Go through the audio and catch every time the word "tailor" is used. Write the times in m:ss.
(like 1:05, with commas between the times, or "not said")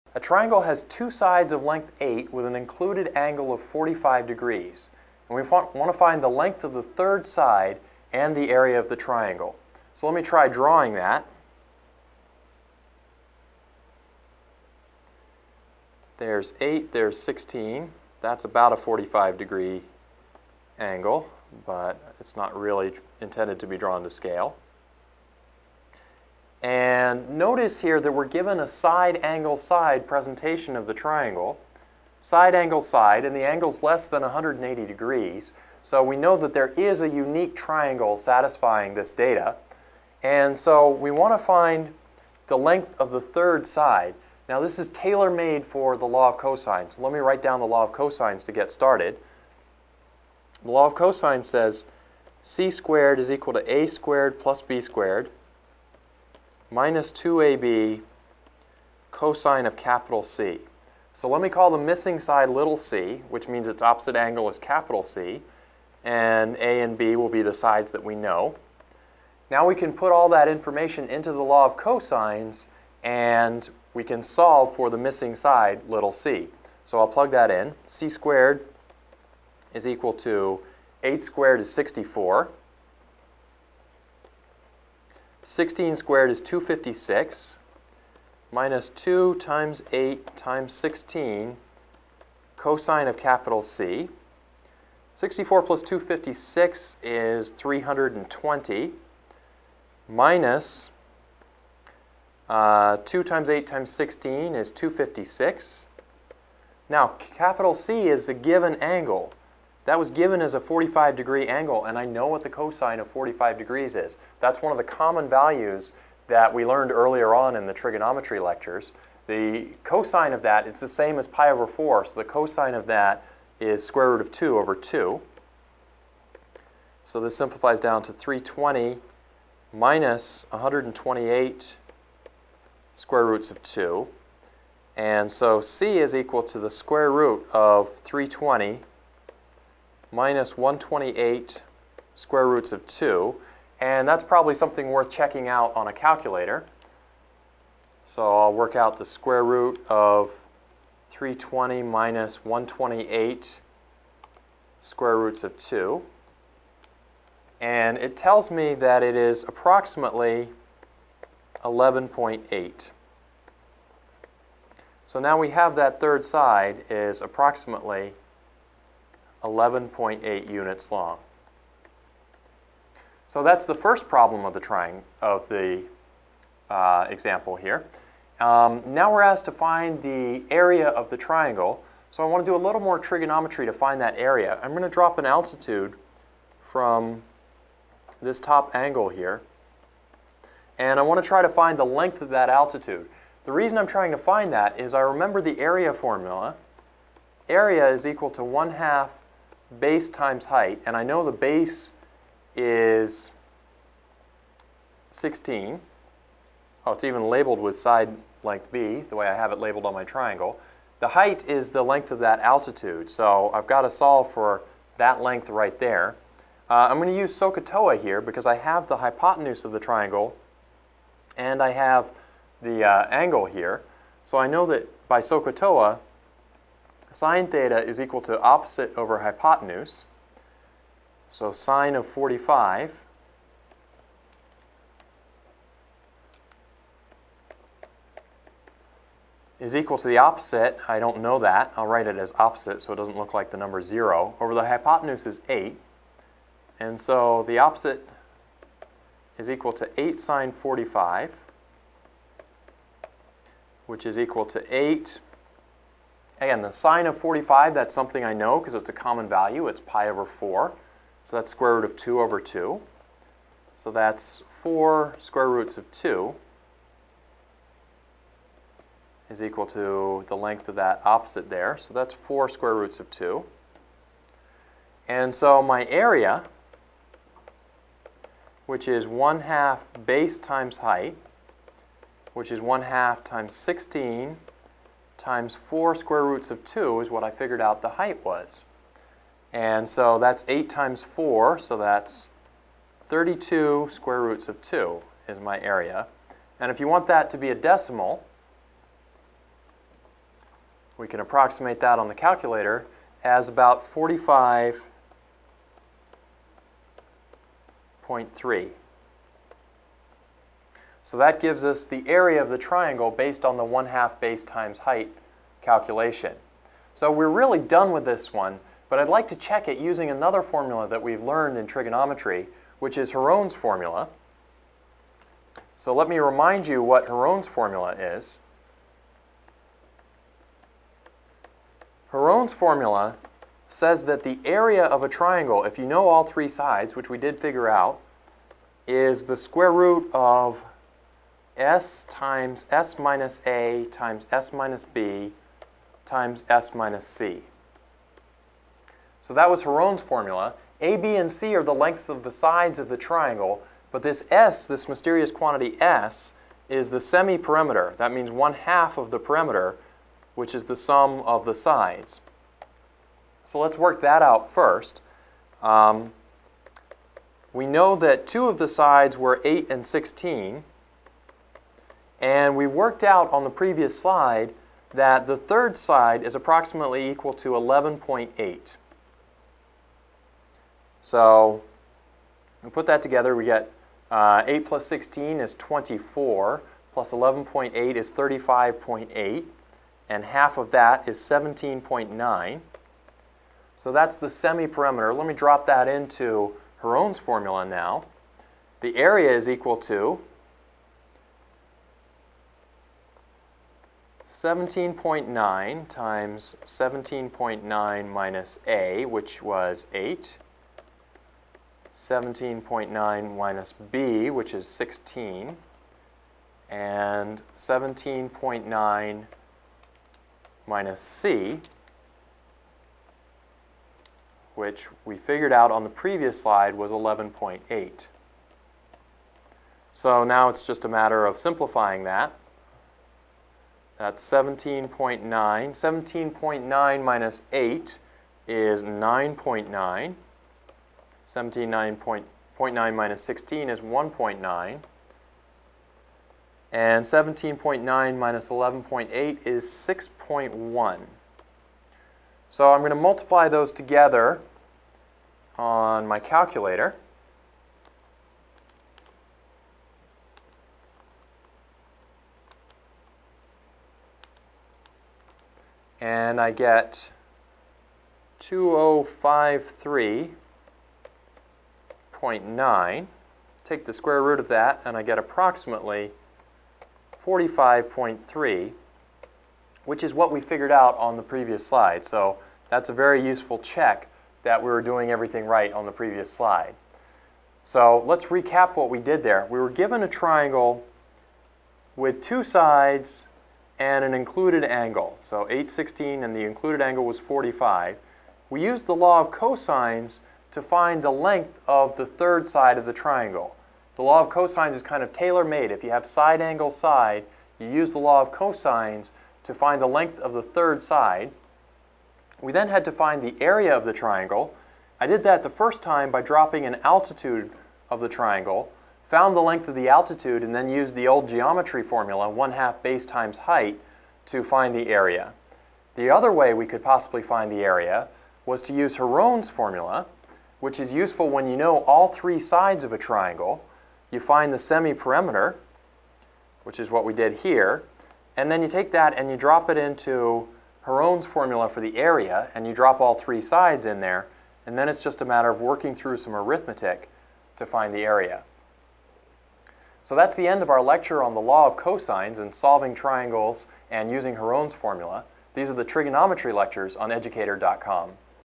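0:44, 8:25.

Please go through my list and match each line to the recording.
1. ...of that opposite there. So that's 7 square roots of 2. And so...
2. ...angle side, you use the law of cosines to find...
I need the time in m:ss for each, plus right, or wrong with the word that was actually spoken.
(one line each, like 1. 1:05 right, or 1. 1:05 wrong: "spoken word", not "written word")
1. 4:30 wrong: "4", not "7"
2. 8:26 right.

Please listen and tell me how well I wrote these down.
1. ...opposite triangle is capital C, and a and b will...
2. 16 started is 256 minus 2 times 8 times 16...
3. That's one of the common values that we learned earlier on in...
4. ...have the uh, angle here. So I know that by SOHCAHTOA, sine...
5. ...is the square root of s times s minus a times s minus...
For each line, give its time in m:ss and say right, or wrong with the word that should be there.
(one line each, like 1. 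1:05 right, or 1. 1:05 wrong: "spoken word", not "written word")
1. 1:03 wrong: "angle", not "triangle"
2. 1:25 wrong: "squared", not "started"
3. 1:54 right
4. 3:41 right
5. 5:38 right.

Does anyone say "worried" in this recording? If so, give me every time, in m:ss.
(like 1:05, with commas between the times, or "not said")
not said.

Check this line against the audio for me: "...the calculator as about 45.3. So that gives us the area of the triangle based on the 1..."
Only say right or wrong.
right.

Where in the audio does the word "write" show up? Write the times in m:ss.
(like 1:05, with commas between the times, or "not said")
0:47, 4:01.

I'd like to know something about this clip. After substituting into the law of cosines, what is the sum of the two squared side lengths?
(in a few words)
320.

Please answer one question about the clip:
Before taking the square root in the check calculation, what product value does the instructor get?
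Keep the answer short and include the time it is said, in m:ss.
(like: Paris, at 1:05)
2053.9, at 7:48.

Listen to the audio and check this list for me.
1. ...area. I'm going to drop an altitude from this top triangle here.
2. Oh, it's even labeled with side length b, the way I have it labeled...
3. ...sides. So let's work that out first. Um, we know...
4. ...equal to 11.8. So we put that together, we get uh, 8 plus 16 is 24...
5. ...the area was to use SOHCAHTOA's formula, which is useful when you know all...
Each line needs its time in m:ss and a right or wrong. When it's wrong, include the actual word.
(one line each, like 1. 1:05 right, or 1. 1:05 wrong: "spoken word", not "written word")
1. 3:04 wrong: "angle", not "triangle"
2. 3:26 right
3. 6:01 right
4. 6:17 right
5. 8:47 wrong: "Heron", not "SOHCAHTOA".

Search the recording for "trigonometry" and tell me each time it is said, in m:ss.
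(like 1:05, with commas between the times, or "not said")
1:57, 3:02, 5:21, 9:15.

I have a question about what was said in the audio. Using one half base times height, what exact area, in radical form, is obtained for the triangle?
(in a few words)
32 square roots of 2.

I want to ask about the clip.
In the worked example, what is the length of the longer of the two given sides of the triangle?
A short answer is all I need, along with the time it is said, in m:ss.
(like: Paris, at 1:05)
16, at 0:16.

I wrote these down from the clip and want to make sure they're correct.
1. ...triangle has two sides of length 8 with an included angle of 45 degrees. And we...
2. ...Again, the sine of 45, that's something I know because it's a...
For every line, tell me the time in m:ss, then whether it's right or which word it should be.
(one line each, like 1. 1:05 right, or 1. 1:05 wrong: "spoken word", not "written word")
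1. 0:00 right
2. 4:16 right.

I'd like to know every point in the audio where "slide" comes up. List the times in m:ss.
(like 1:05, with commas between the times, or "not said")
6:13, 7:06, 8:01, 8:06.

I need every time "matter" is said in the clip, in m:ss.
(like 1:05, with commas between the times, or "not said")
7:10, 9:05.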